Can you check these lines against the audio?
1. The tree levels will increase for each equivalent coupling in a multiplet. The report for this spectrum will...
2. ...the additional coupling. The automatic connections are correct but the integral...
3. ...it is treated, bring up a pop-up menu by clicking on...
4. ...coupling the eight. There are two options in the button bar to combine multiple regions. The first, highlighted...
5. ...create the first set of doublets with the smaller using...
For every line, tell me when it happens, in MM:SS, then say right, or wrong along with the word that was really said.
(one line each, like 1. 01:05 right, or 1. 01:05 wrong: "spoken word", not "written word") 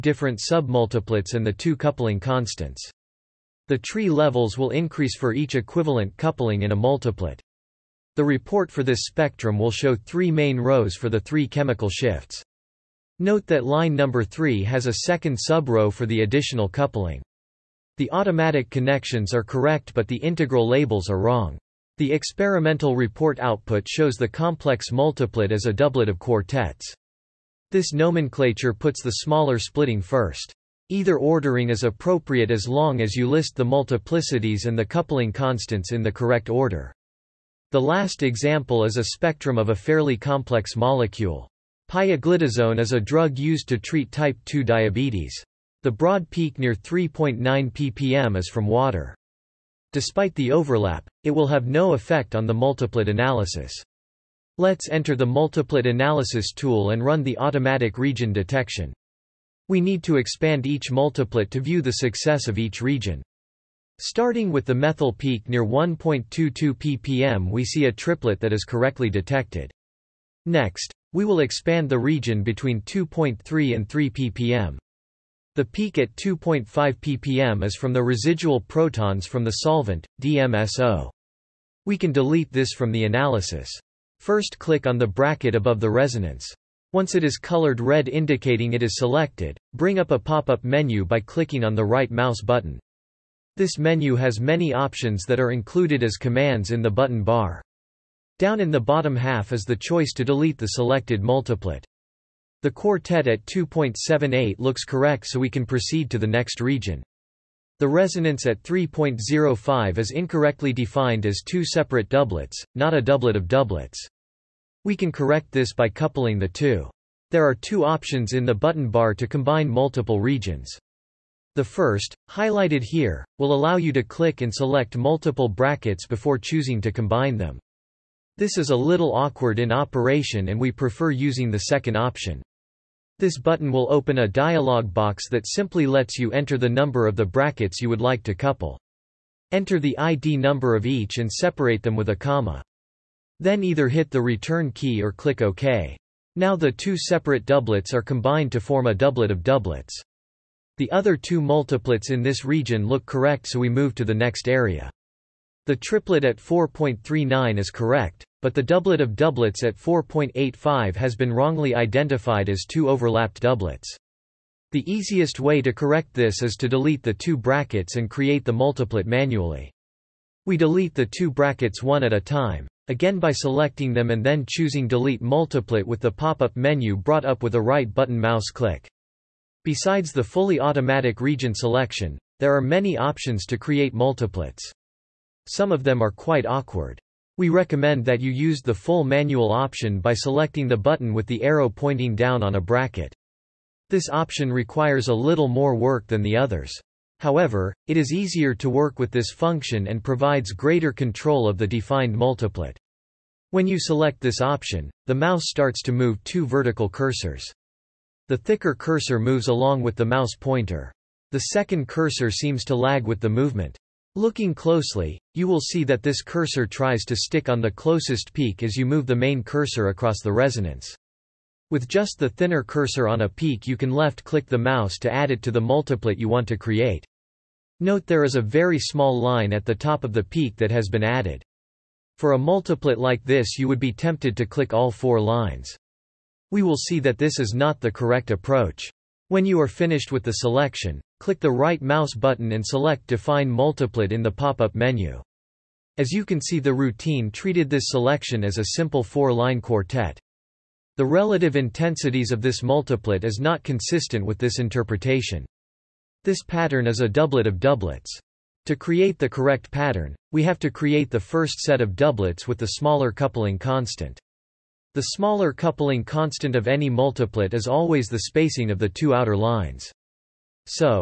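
1. 00:03 right
2. 00:16 right
3. 01:28 wrong: "selected", not "treated"
4. 01:55 wrong: "two", not "eight"
5. 04:20 wrong: "coupling", not "using".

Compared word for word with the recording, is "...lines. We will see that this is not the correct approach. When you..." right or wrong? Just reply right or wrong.
right.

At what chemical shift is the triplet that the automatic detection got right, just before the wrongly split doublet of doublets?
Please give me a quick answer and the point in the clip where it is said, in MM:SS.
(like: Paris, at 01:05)
4.39 ppm, at 02:36.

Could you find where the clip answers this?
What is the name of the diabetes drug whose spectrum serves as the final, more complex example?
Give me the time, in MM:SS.
00:41.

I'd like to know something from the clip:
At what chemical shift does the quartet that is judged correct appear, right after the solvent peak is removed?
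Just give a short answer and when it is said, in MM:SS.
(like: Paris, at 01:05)
2.78 ppm, at 01:43.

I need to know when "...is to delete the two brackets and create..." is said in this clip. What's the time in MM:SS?
02:46.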